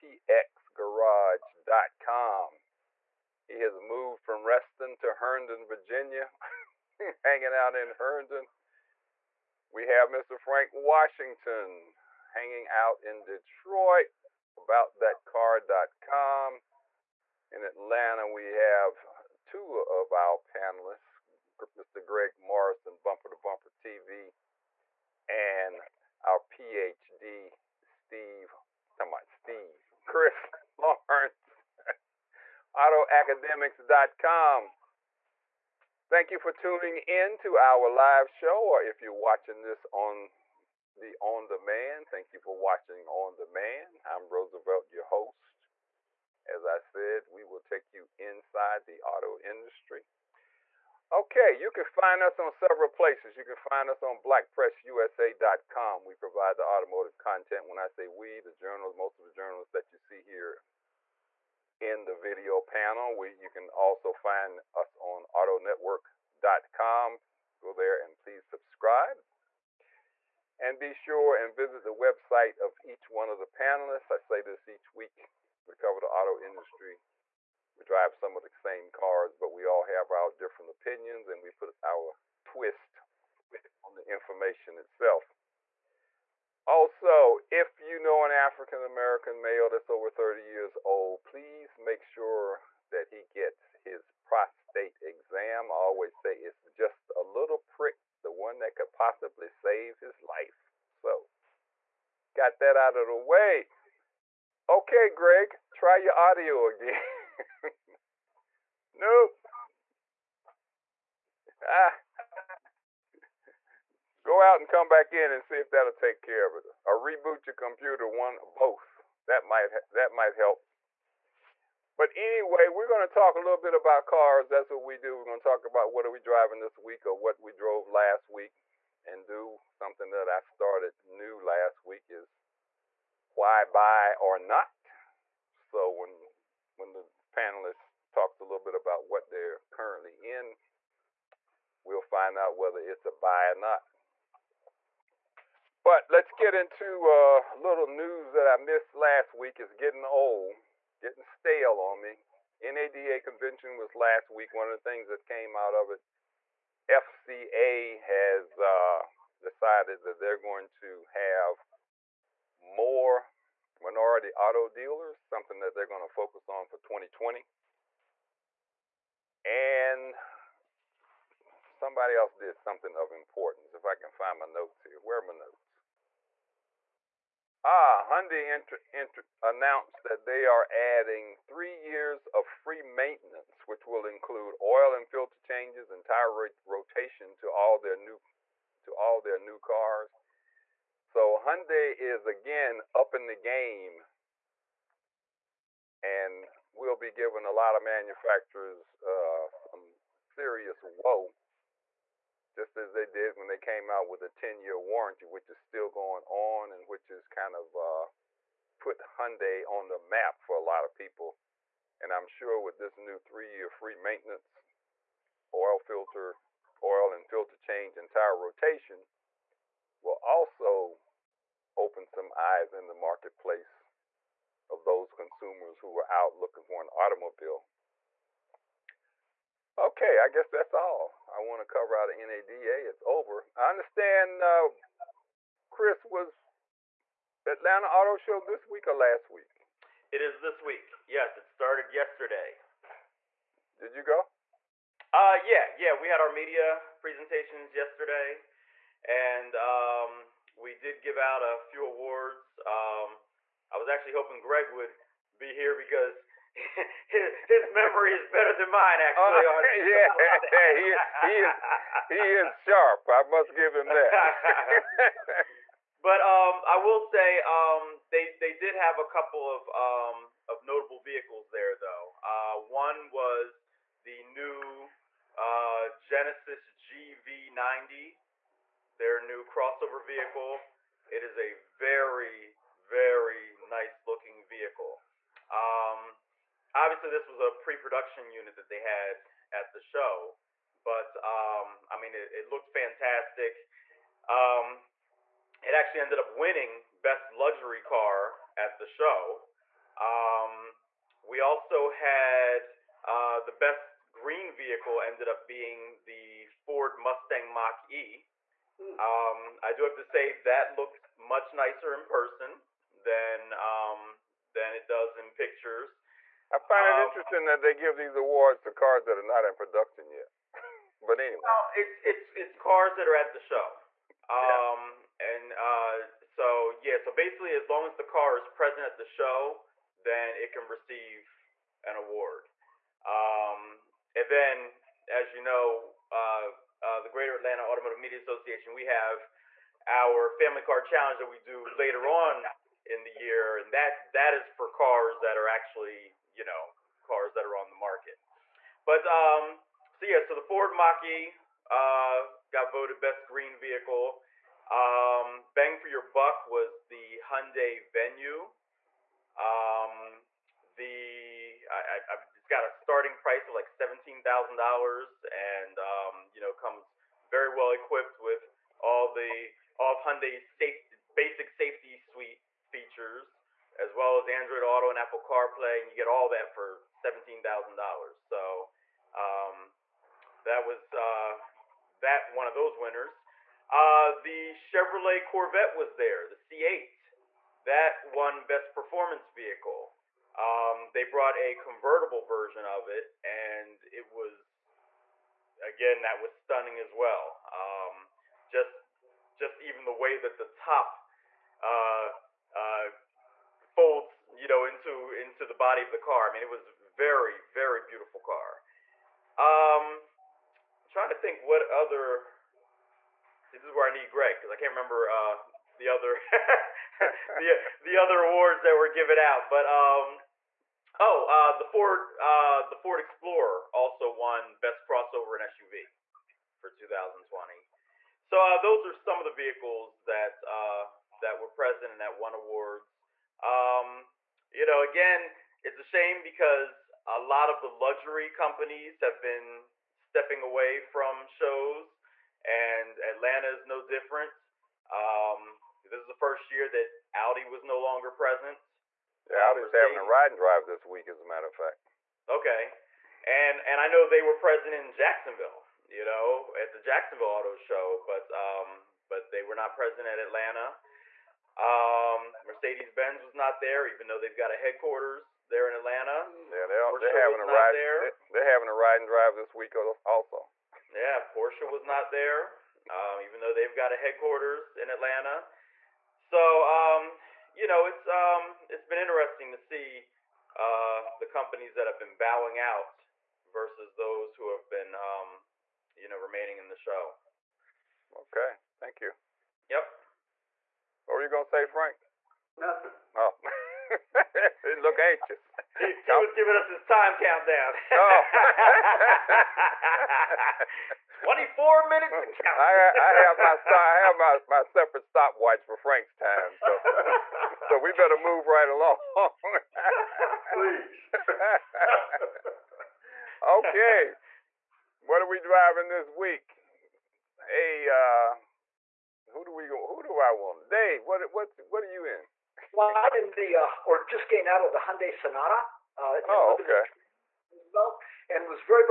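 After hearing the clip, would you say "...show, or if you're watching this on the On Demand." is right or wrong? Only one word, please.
right.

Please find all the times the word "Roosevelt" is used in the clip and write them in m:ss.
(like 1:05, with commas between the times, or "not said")
0:44, 8:47.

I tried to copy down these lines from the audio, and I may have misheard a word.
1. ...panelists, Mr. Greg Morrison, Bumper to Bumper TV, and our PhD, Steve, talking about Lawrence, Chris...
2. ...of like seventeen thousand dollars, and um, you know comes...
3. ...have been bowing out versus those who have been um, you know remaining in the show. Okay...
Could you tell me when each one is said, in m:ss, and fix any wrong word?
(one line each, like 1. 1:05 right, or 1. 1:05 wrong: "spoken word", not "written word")
1. 0:20 wrong: "Steve", not "Lawrence"
2. 6:03 right
3. 8:01 right.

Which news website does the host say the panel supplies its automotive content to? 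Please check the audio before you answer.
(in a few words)
blackpressusa.com.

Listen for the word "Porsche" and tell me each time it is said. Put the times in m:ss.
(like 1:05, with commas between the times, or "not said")
7:46, 7:51.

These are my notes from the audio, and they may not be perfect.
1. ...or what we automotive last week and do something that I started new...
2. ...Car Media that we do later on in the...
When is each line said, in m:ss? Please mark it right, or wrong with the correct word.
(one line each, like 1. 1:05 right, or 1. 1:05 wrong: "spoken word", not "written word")
1. 2:07 wrong: "drove", not "automotive"
2. 5:40 wrong: "Challenge", not "Media".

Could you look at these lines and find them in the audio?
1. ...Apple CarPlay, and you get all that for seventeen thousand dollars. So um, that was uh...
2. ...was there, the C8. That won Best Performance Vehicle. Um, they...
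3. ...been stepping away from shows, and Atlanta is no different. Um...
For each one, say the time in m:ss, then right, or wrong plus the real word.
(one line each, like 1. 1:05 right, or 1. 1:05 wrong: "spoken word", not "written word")
1. 6:14 right
2. 6:25 right
3. 7:19 right.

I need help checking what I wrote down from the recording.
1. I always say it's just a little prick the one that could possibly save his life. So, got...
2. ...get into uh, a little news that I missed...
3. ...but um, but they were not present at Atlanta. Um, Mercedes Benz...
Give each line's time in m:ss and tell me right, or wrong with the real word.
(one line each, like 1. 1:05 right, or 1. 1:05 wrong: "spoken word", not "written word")
1. 1:35 right
2. 2:26 right
3. 7:38 right.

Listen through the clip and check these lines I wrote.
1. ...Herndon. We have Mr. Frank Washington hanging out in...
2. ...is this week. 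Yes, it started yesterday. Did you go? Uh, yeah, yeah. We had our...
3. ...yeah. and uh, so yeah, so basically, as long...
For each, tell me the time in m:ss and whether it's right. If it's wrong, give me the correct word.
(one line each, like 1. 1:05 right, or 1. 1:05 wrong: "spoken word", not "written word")
1. 0:07 right
2. 4:00 right
3. 5:25 right.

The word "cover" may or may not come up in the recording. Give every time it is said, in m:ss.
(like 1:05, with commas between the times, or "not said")
1:15, 3:51.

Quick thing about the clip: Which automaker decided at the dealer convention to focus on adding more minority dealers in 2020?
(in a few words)
FCA.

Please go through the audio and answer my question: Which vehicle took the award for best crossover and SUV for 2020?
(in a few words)
Ford Explorer.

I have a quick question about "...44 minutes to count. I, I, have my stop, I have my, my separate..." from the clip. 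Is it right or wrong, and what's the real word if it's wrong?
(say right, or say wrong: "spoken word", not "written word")
wrong: "24", not "44".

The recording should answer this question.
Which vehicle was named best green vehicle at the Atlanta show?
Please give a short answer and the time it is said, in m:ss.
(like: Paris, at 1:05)
Ford Mustang Mach E, at 5:06.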